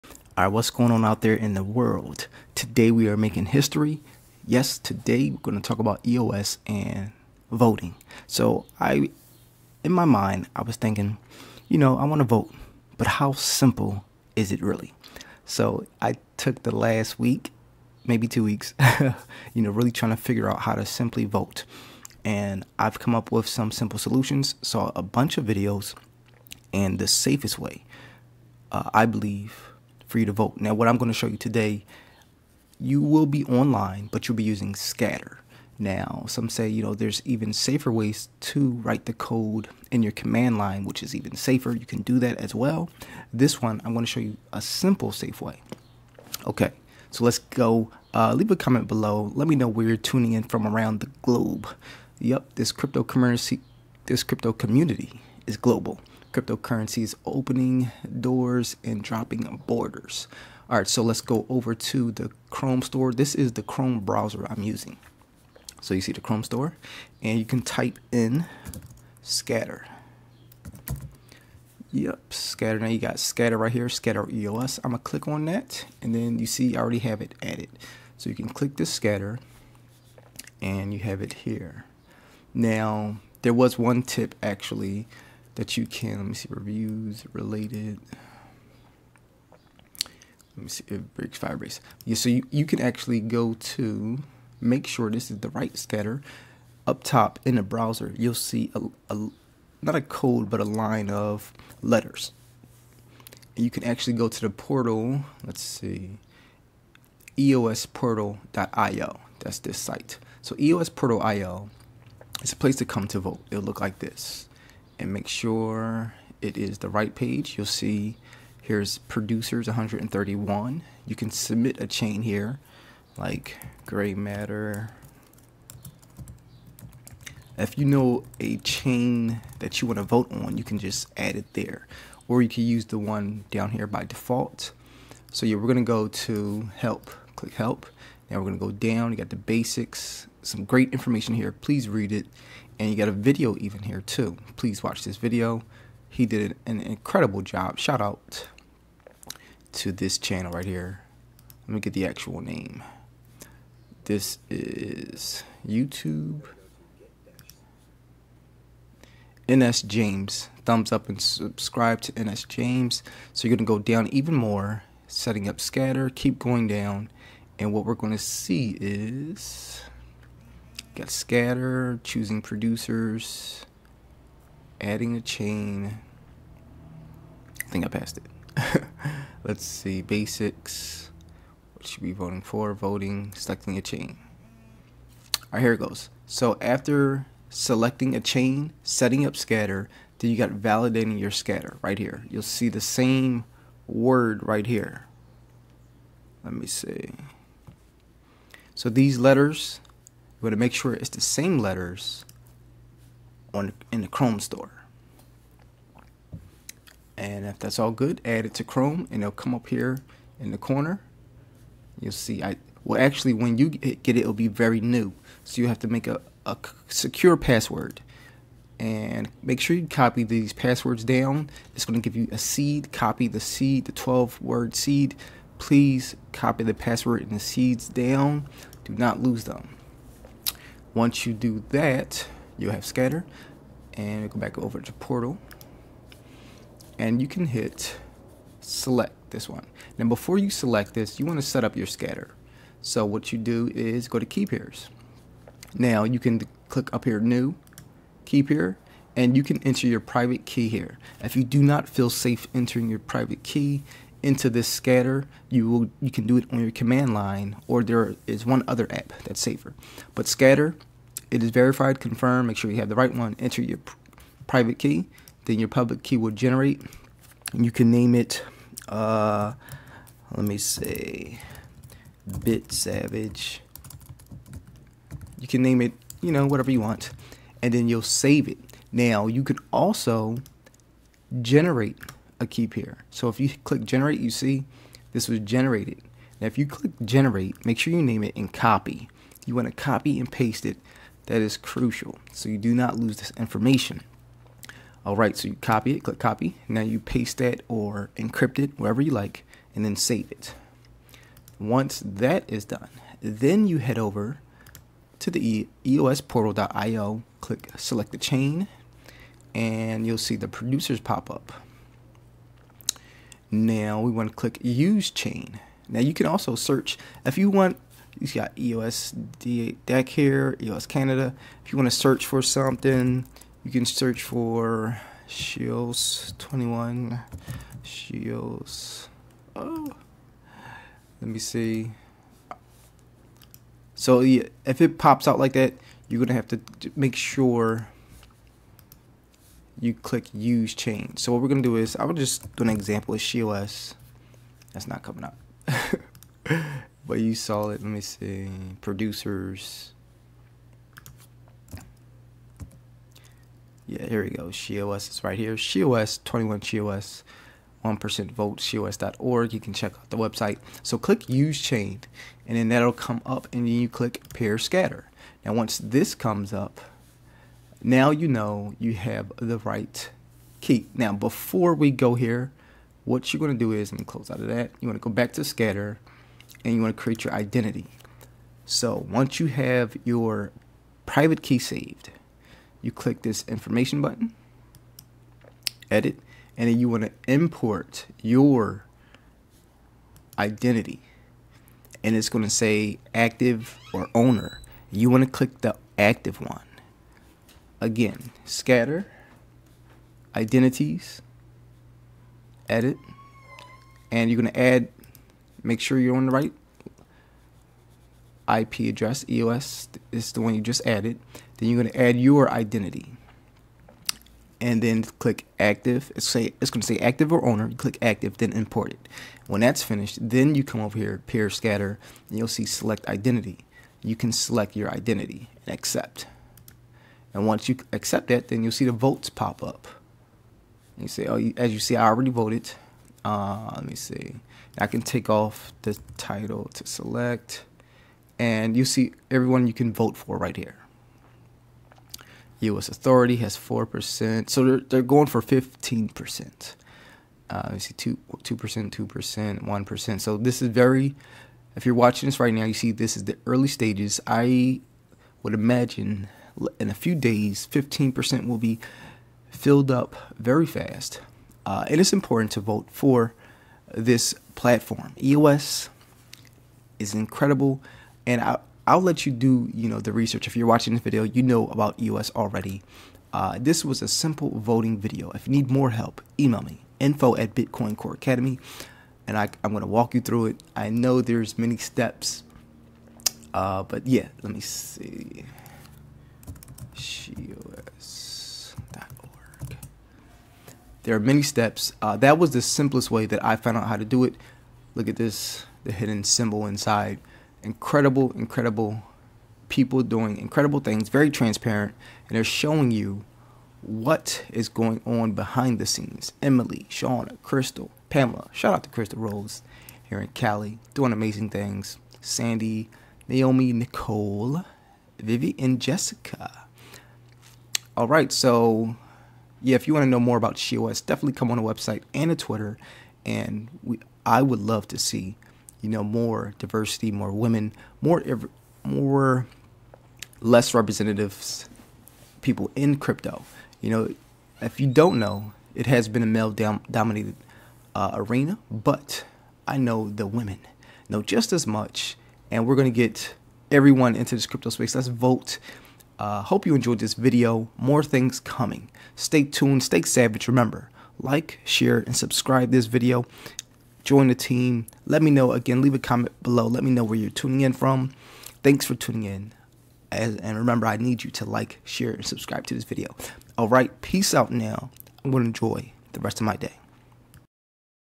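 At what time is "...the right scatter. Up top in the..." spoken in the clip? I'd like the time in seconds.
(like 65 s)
95 s.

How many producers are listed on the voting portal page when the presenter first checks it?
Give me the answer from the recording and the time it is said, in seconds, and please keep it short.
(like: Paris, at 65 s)
131, at 118 s.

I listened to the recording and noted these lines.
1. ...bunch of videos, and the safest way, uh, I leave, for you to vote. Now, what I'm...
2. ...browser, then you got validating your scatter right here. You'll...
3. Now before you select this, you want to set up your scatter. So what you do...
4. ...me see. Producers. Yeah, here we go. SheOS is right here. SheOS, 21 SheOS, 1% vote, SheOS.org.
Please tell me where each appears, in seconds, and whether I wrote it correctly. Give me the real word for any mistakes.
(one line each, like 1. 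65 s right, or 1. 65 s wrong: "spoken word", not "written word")
1. 25 s wrong: "believe", not "leave"
2. 189 s wrong: "scatter", not "browser"
3. 239 s right
4. 347 s right.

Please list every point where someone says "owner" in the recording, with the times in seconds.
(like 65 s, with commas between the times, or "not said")
394 s, 417 s.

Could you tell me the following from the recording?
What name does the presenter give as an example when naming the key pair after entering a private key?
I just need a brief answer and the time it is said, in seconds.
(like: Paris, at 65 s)
Bit Savage, at 272 s.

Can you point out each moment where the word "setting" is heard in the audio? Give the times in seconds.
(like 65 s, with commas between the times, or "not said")
165 s, 188 s.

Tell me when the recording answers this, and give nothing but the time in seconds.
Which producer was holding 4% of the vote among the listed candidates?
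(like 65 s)
442 s.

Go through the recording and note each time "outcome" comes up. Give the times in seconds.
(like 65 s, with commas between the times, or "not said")
not said.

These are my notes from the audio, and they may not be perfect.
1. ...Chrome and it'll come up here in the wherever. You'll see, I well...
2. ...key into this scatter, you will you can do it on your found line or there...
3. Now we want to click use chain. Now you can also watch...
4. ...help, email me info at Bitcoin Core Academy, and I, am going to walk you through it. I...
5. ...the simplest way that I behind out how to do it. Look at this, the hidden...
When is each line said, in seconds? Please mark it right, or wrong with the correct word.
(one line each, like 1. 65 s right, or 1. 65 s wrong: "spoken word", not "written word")
1. 208 s wrong: "corner", not "wherever"
2. 253 s wrong: "command", not "found"
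3. 313 s wrong: "search", not "watch"
4. 475 s right
5. 492 s wrong: "found", not "behind".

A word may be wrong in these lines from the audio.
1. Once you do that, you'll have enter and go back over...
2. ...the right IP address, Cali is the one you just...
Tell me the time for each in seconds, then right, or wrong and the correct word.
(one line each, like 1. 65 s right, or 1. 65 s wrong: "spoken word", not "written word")
1. 230 s wrong: "scatter", not "enter"
2. 406 s wrong: "EOS", not "Cali".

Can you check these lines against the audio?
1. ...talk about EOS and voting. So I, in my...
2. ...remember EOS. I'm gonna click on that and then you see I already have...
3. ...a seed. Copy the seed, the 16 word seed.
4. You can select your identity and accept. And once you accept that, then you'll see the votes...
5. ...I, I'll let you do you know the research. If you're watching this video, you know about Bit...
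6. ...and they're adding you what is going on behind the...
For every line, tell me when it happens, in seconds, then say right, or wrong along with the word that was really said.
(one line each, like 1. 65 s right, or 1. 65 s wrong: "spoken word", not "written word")
1. 5 s right
2. 73 s wrong: "scatter", not "remember"
3. 222 s wrong: "12", not "16"
4. 424 s right
5. 468 s wrong: "EOS", not "Bit"
6. 502 s wrong: "showing", not "adding".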